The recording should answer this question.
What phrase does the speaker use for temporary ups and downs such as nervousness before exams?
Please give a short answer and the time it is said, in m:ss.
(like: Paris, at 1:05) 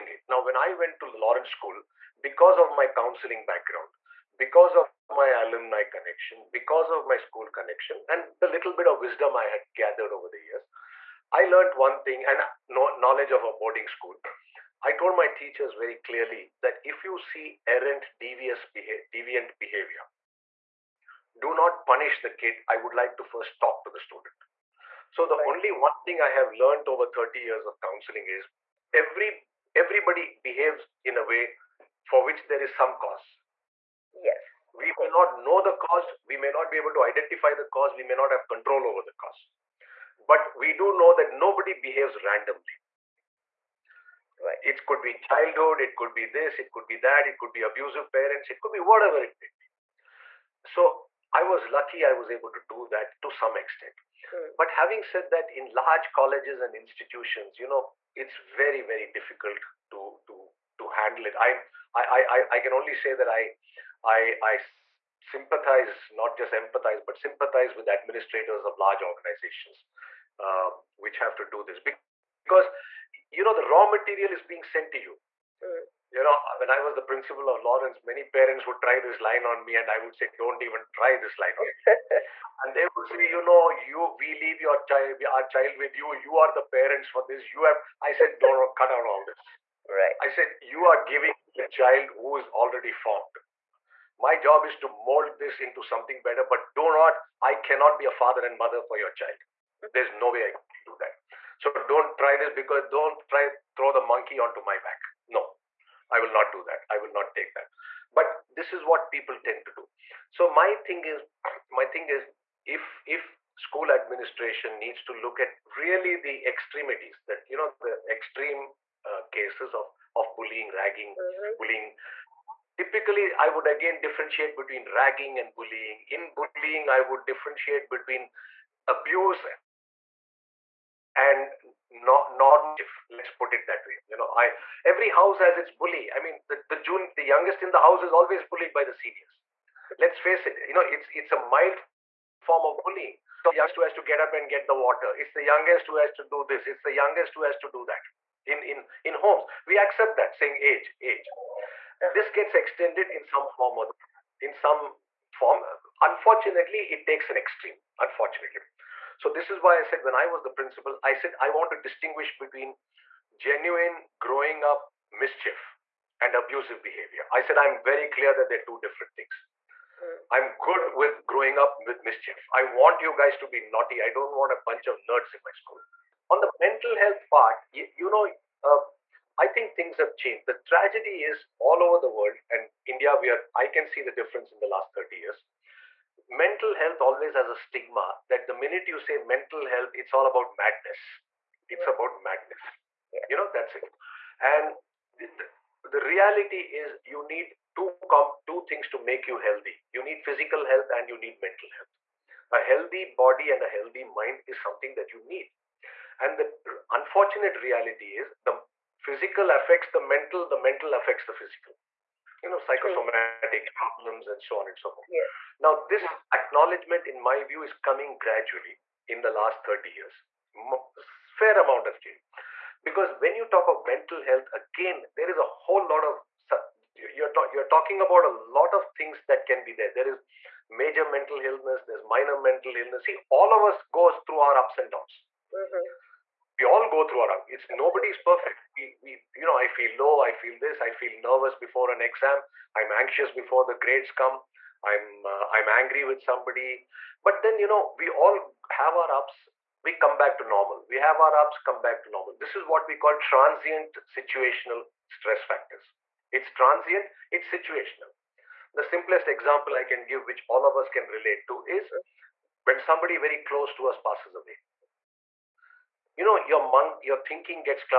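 transient situational stress factors, at 4:13.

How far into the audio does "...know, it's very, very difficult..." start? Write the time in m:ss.
0:57.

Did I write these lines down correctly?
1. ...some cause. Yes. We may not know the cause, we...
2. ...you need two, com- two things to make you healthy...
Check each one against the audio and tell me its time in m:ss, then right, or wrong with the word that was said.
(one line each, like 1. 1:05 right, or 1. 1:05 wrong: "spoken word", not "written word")
1. 0:32 right
2. 3:17 right.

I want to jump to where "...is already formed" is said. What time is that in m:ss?
1:32.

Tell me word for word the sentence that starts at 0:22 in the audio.
I would like to first talk to the student.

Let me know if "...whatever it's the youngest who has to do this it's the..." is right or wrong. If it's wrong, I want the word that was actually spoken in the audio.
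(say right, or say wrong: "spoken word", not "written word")
wrong: "water", not "whatever".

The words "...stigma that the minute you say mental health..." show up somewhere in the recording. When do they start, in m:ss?
3:07.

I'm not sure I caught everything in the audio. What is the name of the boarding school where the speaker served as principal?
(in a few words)
Lawrence School.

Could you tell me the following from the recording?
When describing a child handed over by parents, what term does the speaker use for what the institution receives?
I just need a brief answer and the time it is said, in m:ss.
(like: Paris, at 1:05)
raw material, at 1:13.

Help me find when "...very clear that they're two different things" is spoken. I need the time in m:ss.
2:47.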